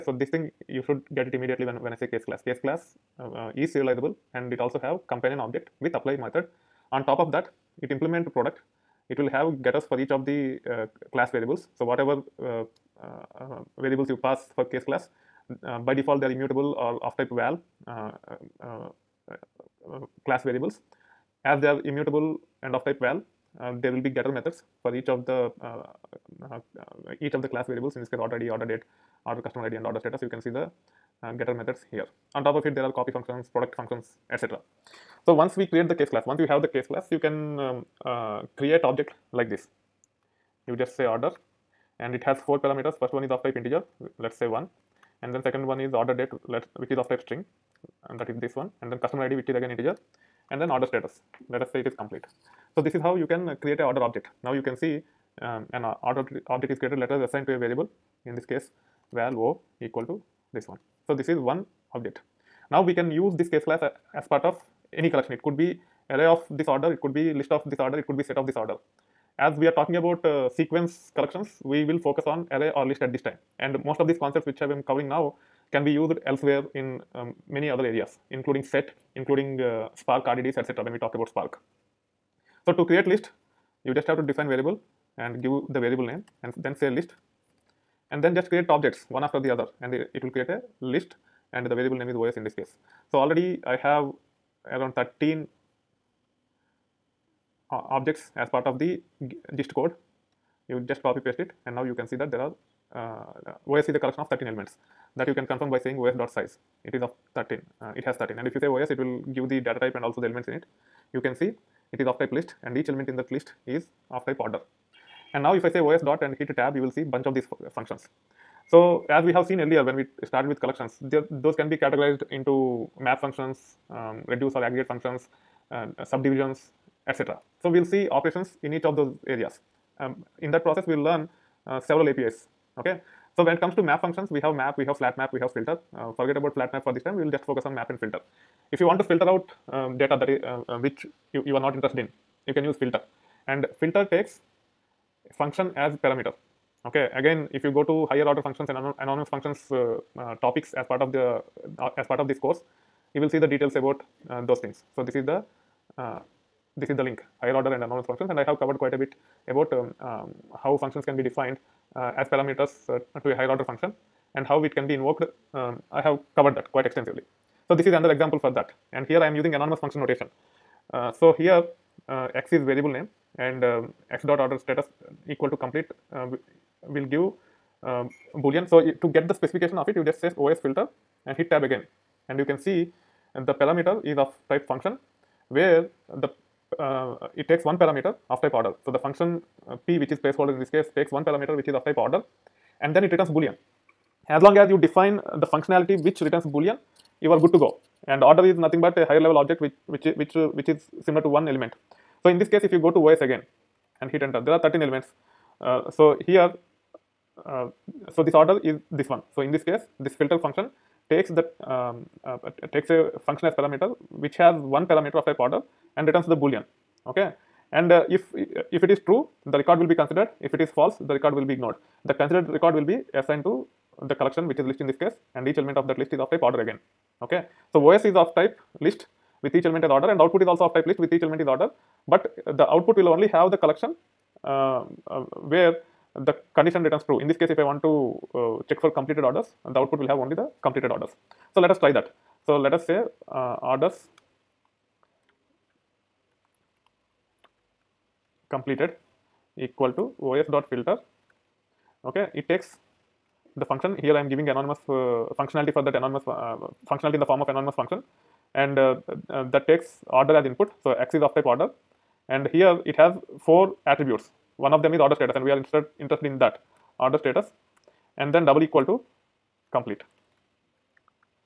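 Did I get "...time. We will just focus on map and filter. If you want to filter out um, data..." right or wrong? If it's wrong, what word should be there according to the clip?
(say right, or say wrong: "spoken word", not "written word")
right.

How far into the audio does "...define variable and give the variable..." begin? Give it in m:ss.
1:24.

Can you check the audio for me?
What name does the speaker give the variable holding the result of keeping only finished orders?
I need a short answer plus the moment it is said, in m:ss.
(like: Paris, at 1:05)
orders completed, at 4:03.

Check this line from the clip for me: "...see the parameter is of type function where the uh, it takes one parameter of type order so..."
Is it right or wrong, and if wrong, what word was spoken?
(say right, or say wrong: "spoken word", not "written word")
right.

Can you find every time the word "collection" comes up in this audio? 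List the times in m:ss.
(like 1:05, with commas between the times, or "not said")
1:05, 1:11, 1:43, 2:00, 3:44, 3:53.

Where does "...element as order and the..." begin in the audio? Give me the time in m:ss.
3:49.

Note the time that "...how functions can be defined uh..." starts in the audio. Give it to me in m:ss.
2:40.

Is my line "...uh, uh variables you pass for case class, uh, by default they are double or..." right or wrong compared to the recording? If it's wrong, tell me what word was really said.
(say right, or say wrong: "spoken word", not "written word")
wrong: "immutable", not "double".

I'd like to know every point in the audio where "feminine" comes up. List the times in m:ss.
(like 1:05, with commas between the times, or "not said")
not said.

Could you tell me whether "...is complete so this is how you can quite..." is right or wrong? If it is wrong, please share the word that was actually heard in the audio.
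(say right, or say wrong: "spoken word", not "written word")
wrong: "create", not "quite".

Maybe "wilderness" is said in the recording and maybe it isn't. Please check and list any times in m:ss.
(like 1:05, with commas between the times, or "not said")
not said.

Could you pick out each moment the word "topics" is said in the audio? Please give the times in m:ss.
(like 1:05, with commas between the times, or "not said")
2:30.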